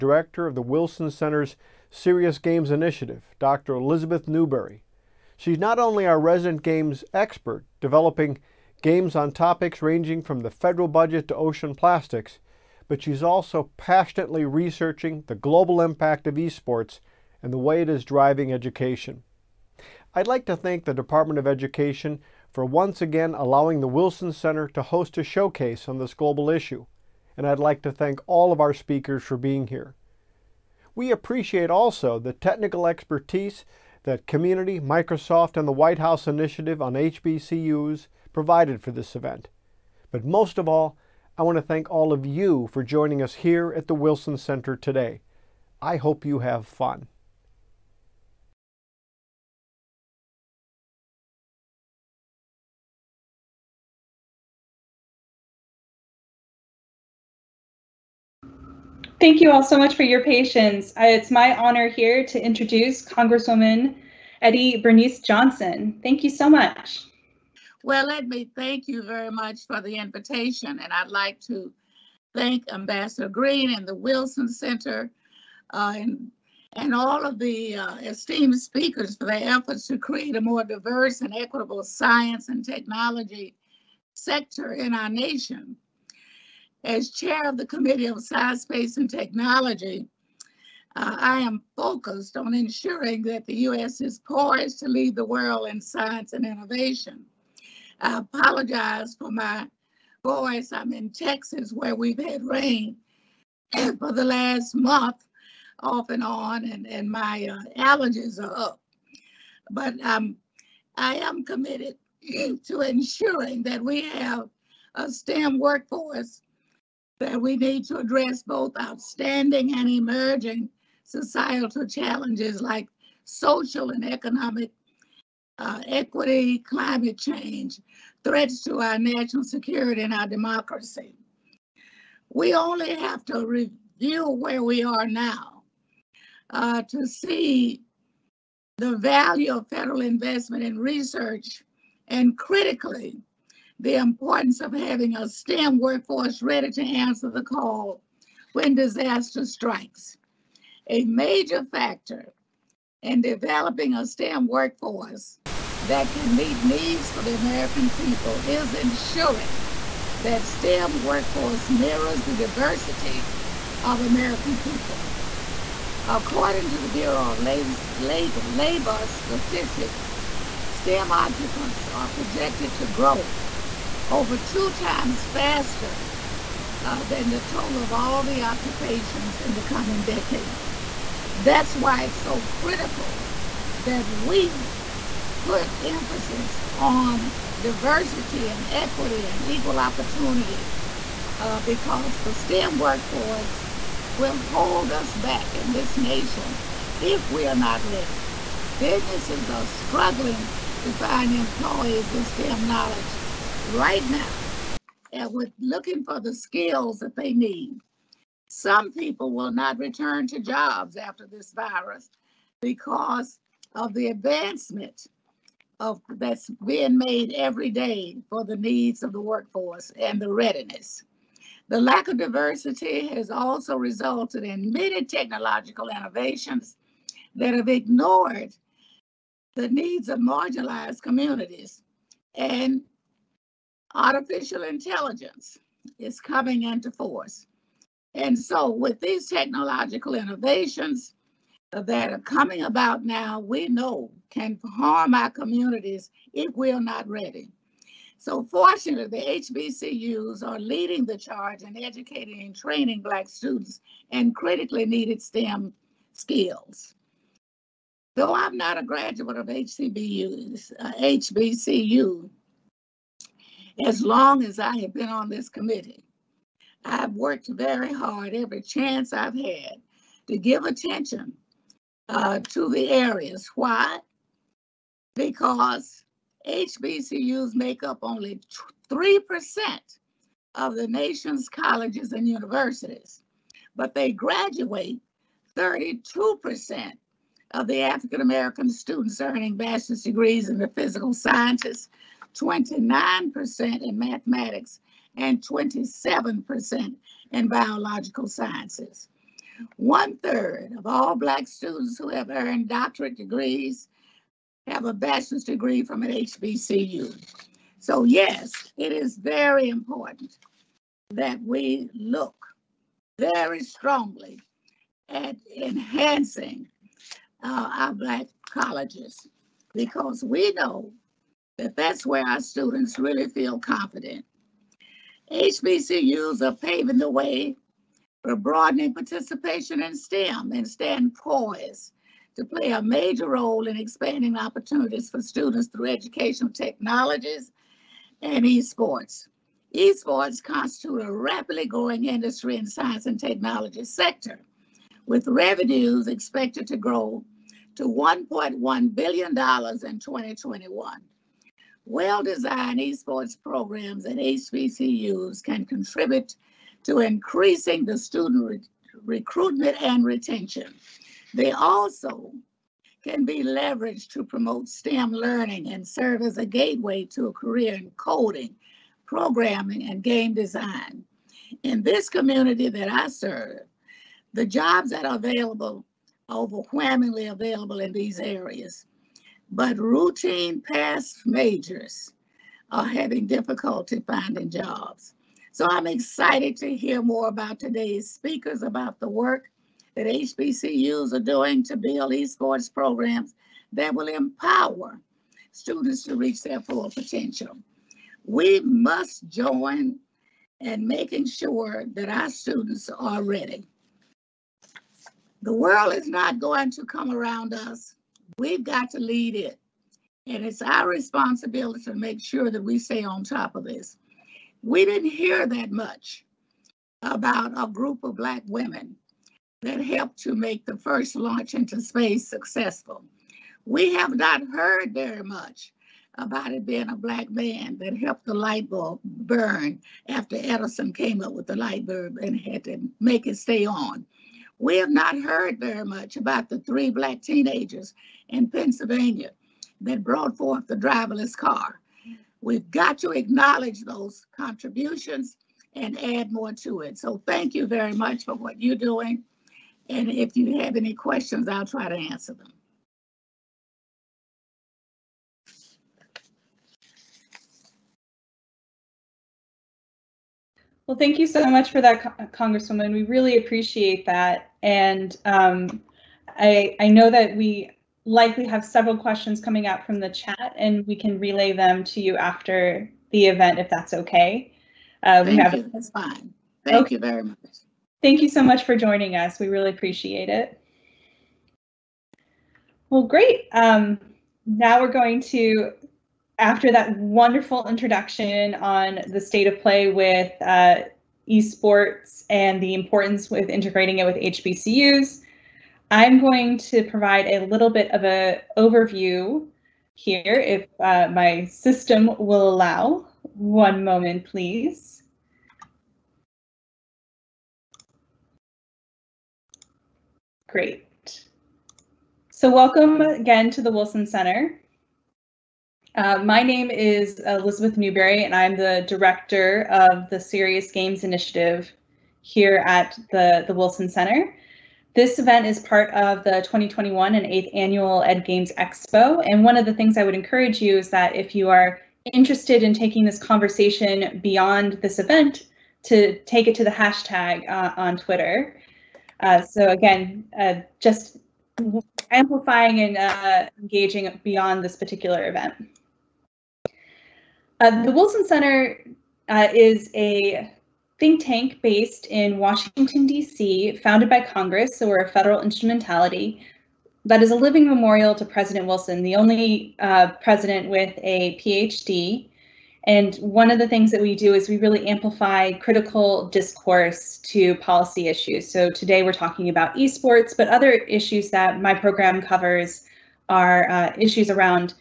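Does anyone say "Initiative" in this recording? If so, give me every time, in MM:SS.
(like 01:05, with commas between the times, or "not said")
00:02, 00:36, 08:41.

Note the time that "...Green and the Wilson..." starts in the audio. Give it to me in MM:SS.
01:13.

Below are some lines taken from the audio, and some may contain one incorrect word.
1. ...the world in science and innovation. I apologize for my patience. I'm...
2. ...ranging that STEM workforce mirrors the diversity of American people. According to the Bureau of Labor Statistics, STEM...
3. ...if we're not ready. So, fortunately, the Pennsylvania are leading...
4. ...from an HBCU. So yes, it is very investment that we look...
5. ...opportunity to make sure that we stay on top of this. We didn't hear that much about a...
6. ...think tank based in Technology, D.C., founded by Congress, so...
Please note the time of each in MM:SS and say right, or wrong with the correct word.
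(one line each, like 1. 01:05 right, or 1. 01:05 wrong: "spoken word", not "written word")
1. 01:35 wrong: "voice", not "patience"
2. 02:38 wrong: "ensuring", not "ranging"
3. 04:06 wrong: "HBCUs", not "Pennsylvania"
4. 05:05 wrong: "important", not "investment"
5. 06:50 wrong: "responsibility", not "opportunity"
6. 09:10 wrong: "Washington", not "Technology".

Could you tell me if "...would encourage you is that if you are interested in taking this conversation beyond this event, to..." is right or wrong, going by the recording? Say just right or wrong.
right.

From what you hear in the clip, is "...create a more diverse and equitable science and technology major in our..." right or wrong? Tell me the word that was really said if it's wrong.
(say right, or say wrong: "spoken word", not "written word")
wrong: "sector", not "major".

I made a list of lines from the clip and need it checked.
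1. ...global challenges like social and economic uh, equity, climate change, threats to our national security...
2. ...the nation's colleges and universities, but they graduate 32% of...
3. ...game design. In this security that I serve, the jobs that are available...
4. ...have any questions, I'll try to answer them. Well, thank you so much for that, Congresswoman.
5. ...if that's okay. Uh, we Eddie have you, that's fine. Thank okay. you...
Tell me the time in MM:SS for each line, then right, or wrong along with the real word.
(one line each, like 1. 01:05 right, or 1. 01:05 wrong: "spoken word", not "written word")
1. 02:01 wrong: "societal", not "global"
2. 04:40 right
3. 06:10 wrong: "community", not "security"
4. 07:30 right
5. 07:53 wrong: "Thank", not "Eddie".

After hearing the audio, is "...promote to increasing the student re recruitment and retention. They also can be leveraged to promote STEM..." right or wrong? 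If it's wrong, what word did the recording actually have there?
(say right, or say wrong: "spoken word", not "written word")
wrong: "contribute", not "promote".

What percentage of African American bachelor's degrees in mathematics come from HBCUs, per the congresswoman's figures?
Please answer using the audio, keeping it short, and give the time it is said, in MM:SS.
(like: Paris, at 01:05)
29%, at 04:52.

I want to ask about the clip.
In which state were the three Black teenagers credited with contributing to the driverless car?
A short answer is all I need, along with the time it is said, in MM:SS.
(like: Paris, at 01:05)
Pennsylvania, at 07:18.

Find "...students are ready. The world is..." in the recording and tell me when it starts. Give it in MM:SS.
06:42.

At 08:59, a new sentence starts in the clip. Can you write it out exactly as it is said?
Uh, so again, uh, just amplifying and uh, engaging beyond this particular event.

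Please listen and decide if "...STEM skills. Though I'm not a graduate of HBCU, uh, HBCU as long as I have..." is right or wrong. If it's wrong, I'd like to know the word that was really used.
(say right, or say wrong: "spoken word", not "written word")
right.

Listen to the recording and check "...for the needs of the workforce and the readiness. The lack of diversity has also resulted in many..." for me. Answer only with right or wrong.
right.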